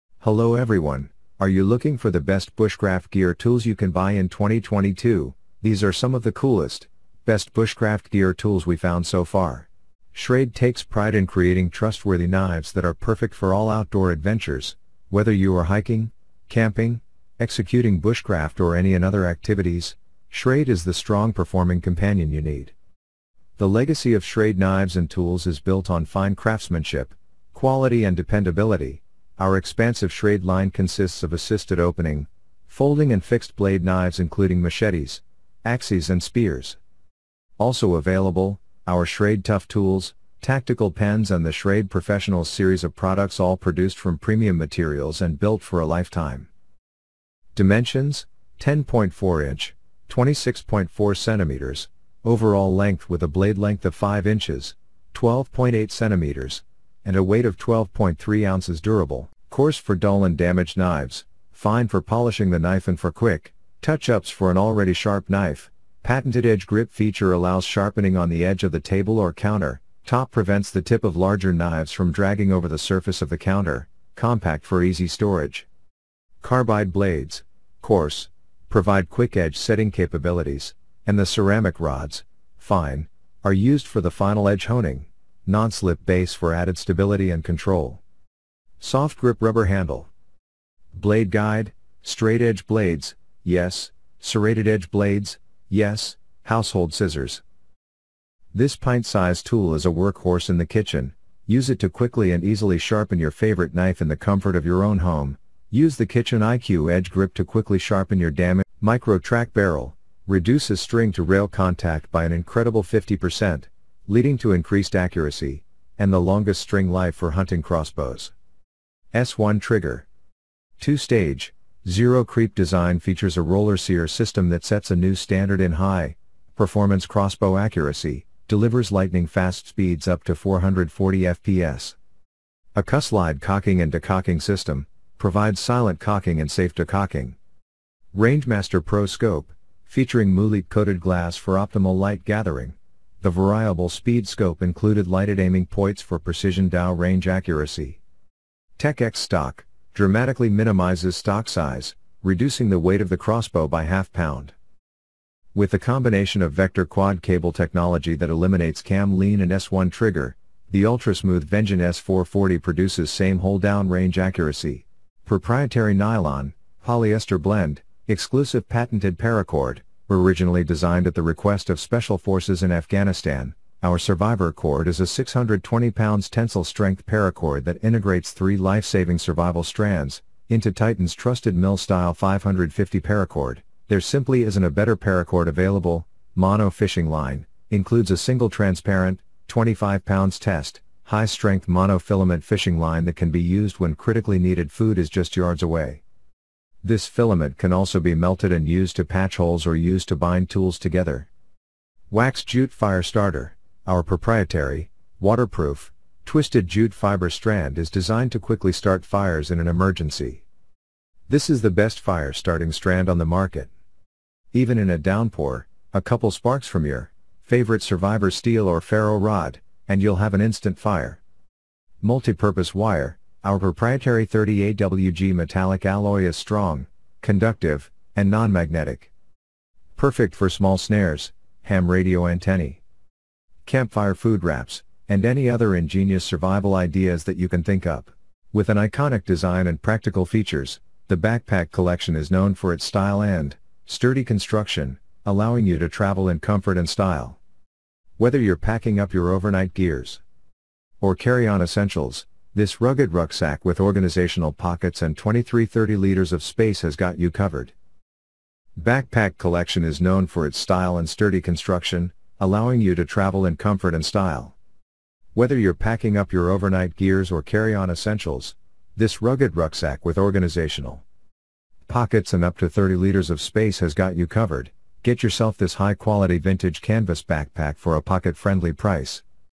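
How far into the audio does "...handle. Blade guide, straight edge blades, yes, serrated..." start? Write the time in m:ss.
1:29.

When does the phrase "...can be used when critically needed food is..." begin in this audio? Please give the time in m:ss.
3:13.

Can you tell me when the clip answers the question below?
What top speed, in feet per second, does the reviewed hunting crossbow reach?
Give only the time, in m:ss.
2:10.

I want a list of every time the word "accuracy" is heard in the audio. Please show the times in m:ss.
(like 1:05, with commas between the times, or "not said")
1:54, 2:07, 2:27, 2:44.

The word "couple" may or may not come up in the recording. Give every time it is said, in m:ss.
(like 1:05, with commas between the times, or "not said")
3:36.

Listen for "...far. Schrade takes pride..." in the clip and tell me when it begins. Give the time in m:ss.
0:09.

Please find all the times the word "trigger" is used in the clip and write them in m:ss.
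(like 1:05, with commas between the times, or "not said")
1:59, 2:39.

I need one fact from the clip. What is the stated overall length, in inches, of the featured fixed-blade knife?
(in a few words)
10.4 inches.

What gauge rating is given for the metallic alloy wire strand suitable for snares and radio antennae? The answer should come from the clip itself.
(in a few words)
30AWG.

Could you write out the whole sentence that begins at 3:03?
There simply isn't a better paracord available.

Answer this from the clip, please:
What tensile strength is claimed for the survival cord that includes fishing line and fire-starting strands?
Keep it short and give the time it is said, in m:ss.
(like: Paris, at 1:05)
620 pounds, at 2:55.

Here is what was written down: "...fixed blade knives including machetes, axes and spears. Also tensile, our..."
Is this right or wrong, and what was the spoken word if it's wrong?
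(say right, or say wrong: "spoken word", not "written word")
wrong: "available", not "tensile".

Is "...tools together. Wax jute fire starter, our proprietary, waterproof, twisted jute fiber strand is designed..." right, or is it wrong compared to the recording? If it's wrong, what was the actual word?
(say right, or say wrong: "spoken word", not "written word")
right.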